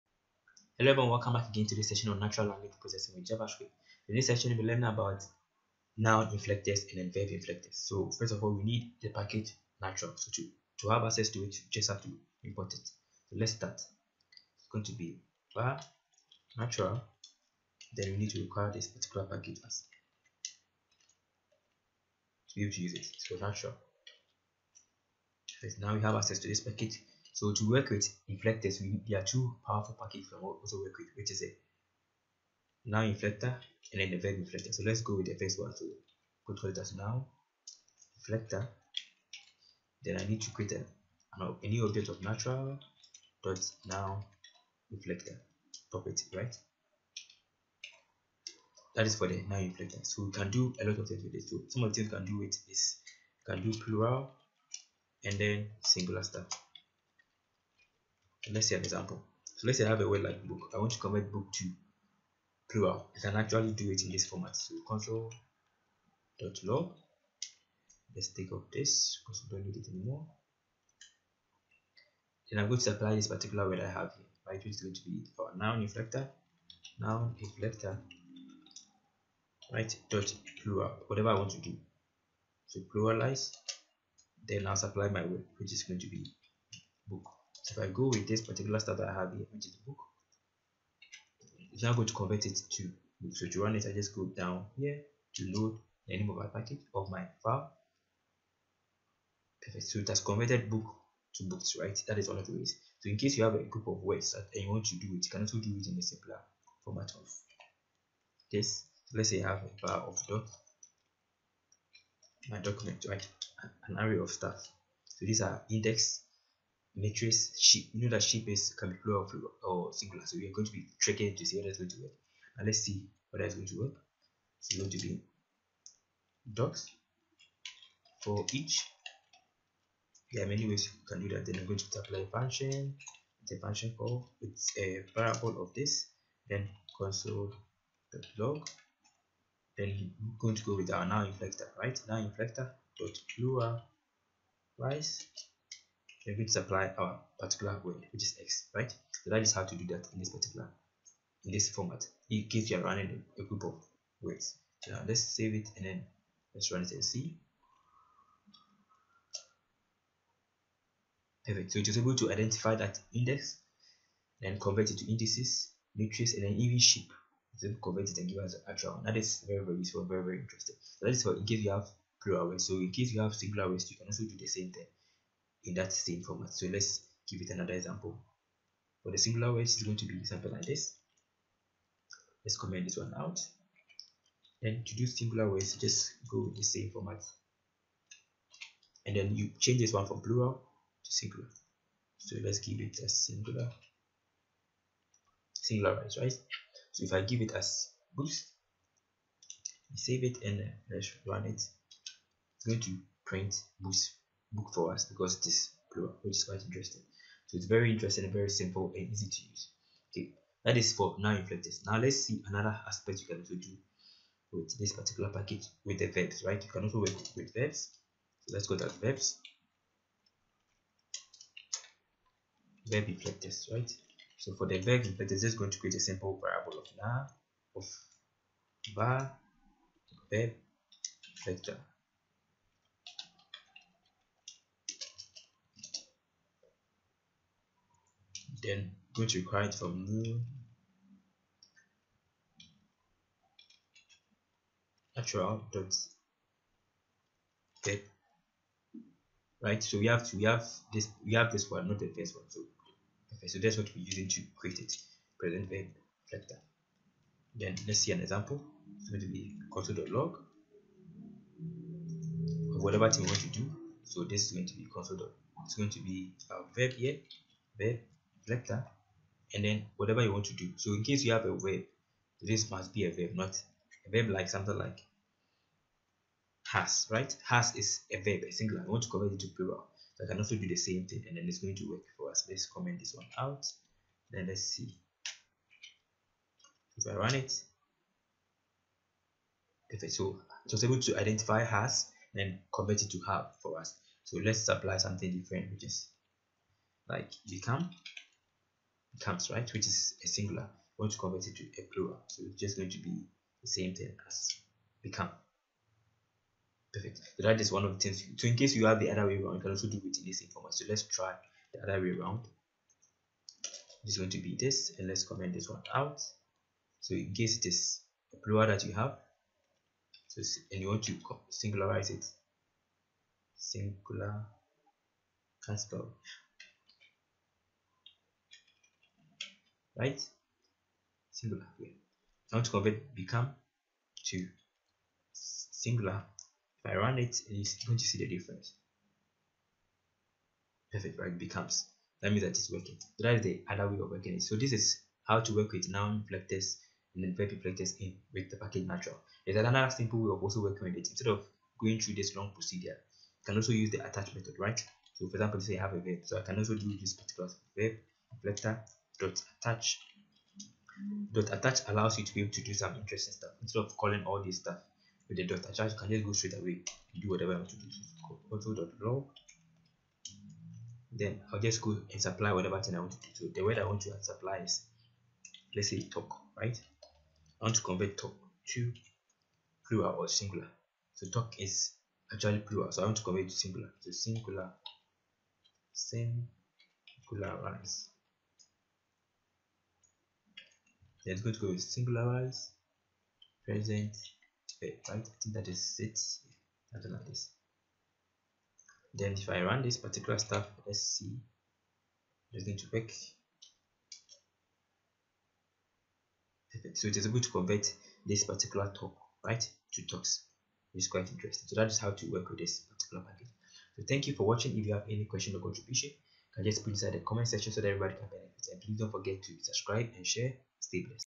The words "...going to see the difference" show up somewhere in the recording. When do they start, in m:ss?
5:37.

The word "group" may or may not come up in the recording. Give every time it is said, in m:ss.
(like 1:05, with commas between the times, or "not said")
1:43, 2:33.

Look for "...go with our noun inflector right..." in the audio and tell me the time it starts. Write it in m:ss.
2:20.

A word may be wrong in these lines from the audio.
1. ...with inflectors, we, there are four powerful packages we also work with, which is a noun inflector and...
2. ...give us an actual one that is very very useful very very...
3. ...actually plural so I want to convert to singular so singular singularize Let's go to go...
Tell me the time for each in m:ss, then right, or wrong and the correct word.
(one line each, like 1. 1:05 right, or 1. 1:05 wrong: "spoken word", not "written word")
1. 0:27 wrong: "two", not "four"
2. 2:48 right
3. 6:22 right.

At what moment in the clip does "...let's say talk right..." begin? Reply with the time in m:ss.
6:15.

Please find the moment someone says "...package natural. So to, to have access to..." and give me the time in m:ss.
0:09.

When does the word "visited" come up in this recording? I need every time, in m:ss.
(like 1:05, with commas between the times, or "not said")
not said.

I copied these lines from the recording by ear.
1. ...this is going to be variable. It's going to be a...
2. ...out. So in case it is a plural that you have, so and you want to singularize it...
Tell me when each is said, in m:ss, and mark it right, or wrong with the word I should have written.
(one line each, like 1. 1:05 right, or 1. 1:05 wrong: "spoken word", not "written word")
1. 4:24 wrong: "console", not "variable"
2. 5:15 right.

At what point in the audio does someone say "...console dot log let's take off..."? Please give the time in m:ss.
1:04.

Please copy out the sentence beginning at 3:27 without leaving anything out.
So it's very interesting and very simple and easy to use.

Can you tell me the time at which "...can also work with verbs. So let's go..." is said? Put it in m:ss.
3:36.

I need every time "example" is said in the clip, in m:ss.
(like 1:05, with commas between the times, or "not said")
0:58, 2:57, 4:18, 5:55.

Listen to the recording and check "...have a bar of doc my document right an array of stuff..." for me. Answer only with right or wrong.
right.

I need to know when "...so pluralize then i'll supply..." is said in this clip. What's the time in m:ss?
1:22.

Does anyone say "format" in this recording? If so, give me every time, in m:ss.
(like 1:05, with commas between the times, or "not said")
1:04, 1:46, 2:31, 2:56, 3:06, 5:10.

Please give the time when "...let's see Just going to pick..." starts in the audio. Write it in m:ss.
6:40.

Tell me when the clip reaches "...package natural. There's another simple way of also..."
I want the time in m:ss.
5:48.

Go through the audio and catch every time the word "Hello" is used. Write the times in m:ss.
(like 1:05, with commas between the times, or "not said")
0:00.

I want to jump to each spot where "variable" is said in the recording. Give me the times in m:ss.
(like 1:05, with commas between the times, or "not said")
2:15, 3:46.